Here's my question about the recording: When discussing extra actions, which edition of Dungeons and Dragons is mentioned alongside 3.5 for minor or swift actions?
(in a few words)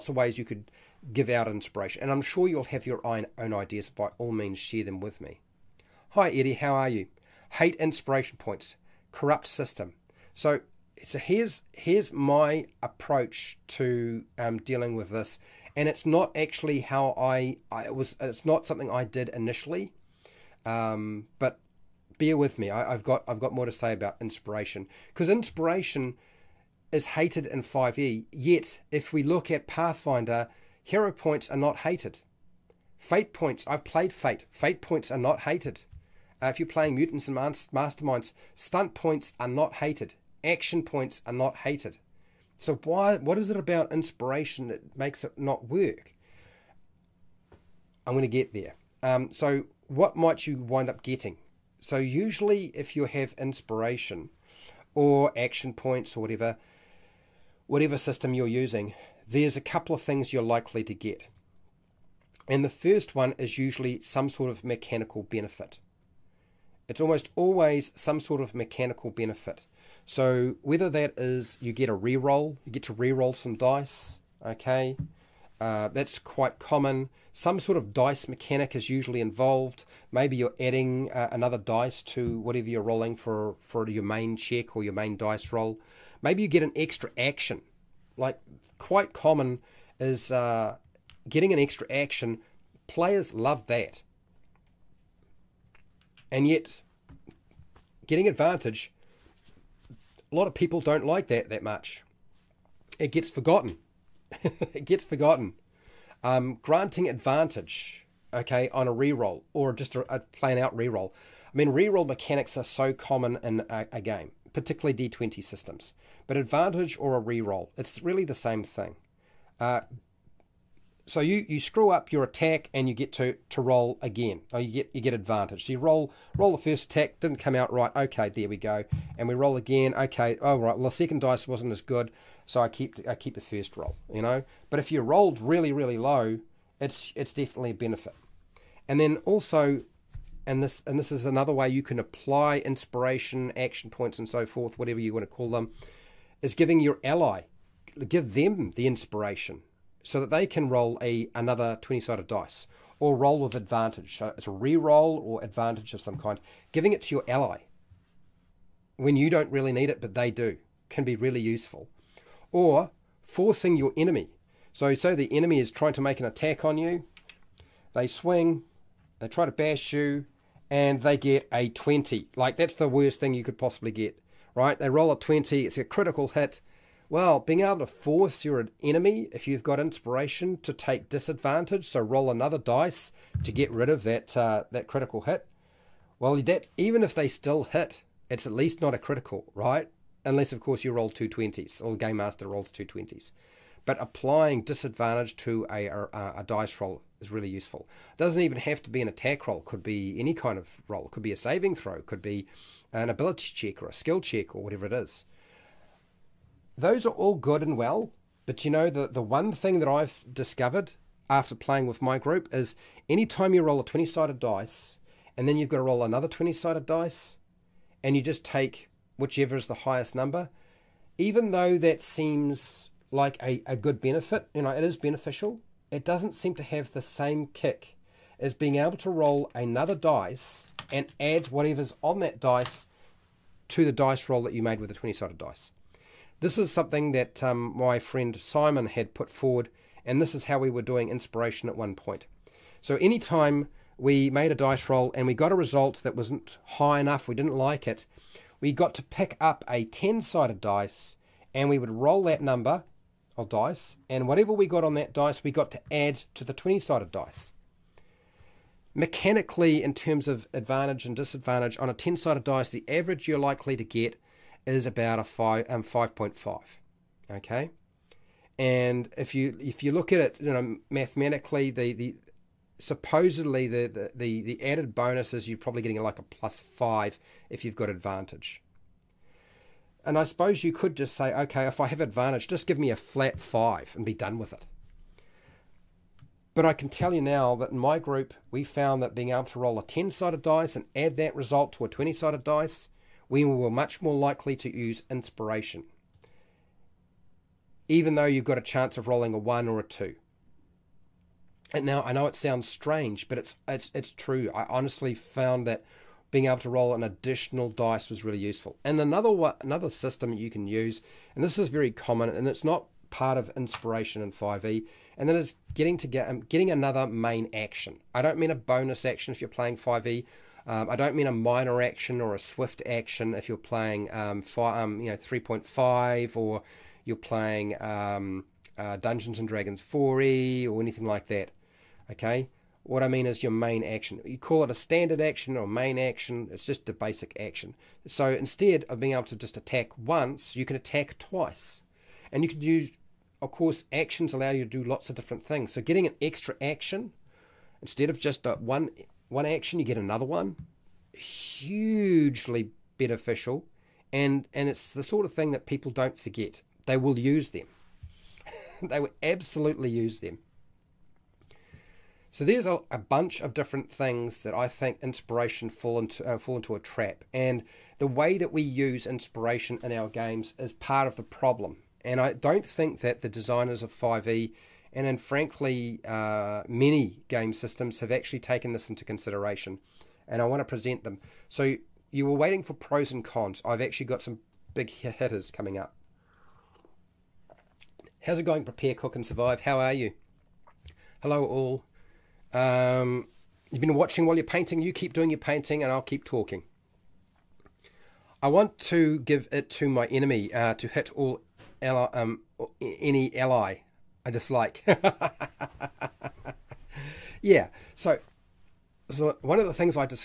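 4e.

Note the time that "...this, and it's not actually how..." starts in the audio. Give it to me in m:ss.
0:15.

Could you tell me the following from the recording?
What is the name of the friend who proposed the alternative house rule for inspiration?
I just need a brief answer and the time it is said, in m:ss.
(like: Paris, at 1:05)
Simon, at 3:58.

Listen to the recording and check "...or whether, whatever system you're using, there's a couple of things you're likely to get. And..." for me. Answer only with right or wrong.
wrong.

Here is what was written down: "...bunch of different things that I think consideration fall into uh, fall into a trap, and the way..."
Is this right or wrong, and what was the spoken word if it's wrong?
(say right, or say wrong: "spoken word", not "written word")
wrong: "inspiration", not "consideration".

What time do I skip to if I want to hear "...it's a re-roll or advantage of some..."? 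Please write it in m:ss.
2:34.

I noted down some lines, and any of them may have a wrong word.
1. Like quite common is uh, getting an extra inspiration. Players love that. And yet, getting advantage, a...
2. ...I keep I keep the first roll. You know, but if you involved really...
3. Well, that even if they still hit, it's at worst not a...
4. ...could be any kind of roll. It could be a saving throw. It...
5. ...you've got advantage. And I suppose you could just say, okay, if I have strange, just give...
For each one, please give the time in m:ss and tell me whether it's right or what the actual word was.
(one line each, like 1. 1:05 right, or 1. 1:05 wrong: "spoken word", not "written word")
1. 1:28 wrong: "action", not "inspiration"
2. 2:12 wrong: "rolled", not "involved"
3. 3:06 wrong: "least", not "worst"
4. 3:19 right
5. 4:37 wrong: "advantage", not "strange".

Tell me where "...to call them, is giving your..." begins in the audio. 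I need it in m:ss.
2:25.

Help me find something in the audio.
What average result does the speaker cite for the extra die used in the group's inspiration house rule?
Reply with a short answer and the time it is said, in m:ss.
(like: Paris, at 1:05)
5.5, at 4:25.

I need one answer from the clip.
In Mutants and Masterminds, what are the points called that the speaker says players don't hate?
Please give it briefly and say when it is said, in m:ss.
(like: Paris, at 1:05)
stunt points, at 0:38.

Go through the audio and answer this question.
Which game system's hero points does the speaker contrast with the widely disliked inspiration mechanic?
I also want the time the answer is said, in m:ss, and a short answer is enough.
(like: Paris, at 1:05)
Pathfinder, at 0:29.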